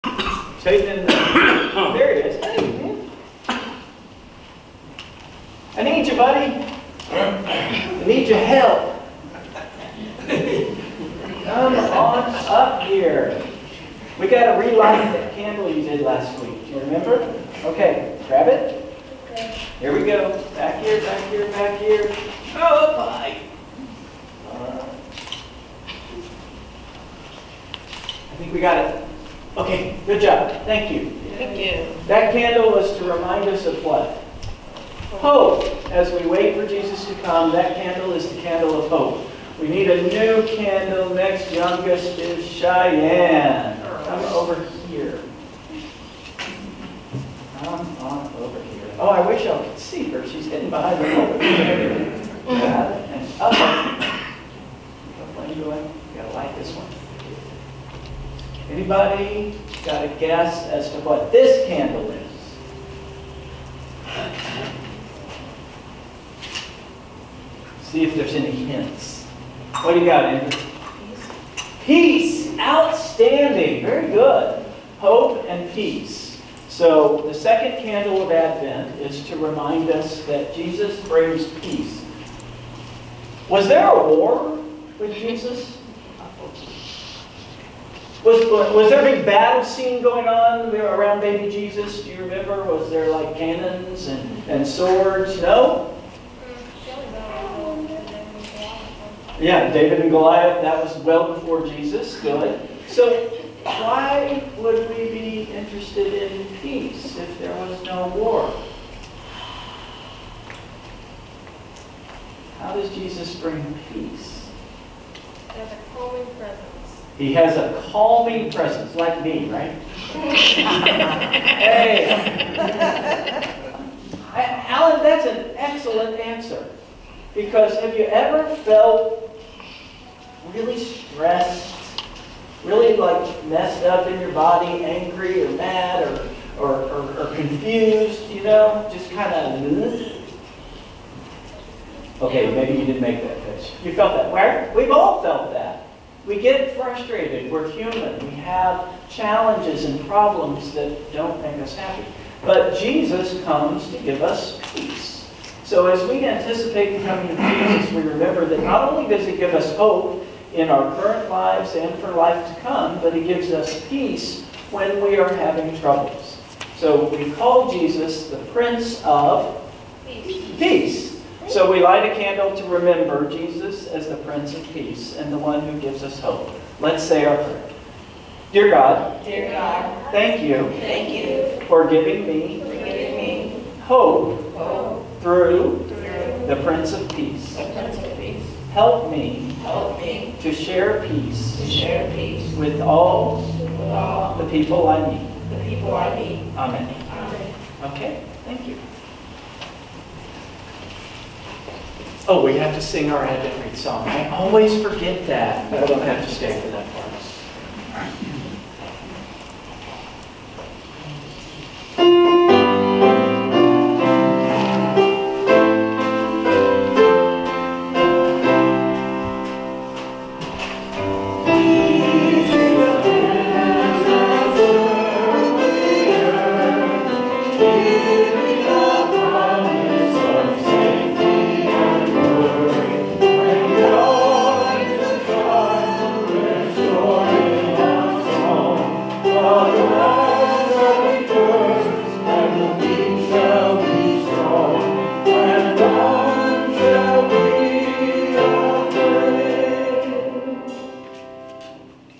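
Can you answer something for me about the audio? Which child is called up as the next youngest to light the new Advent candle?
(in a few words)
Cheyenne.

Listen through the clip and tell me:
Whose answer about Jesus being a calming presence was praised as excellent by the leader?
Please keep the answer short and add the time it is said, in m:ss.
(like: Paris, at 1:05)
Alan, at 2:04.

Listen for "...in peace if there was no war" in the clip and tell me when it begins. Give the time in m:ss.
1:46.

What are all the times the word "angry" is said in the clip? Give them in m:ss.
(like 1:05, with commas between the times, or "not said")
2:14.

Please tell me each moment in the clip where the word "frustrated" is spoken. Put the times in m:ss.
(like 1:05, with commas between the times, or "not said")
2:26.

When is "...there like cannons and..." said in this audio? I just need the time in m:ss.
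1:32.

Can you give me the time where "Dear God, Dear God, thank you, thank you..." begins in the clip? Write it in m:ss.
2:58.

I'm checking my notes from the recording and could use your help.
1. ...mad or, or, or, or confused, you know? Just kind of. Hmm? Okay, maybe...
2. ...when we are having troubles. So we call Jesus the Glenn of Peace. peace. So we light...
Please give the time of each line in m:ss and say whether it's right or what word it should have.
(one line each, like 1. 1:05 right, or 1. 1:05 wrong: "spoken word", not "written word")
1. 2:15 right
2. 2:44 wrong: "Prince", not "Glenn".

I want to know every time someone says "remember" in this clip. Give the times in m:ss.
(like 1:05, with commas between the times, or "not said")
0:16, 1:32, 2:38, 2:52.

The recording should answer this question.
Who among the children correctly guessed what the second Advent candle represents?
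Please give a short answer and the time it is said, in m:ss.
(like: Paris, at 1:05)
Andrew, at 1:10.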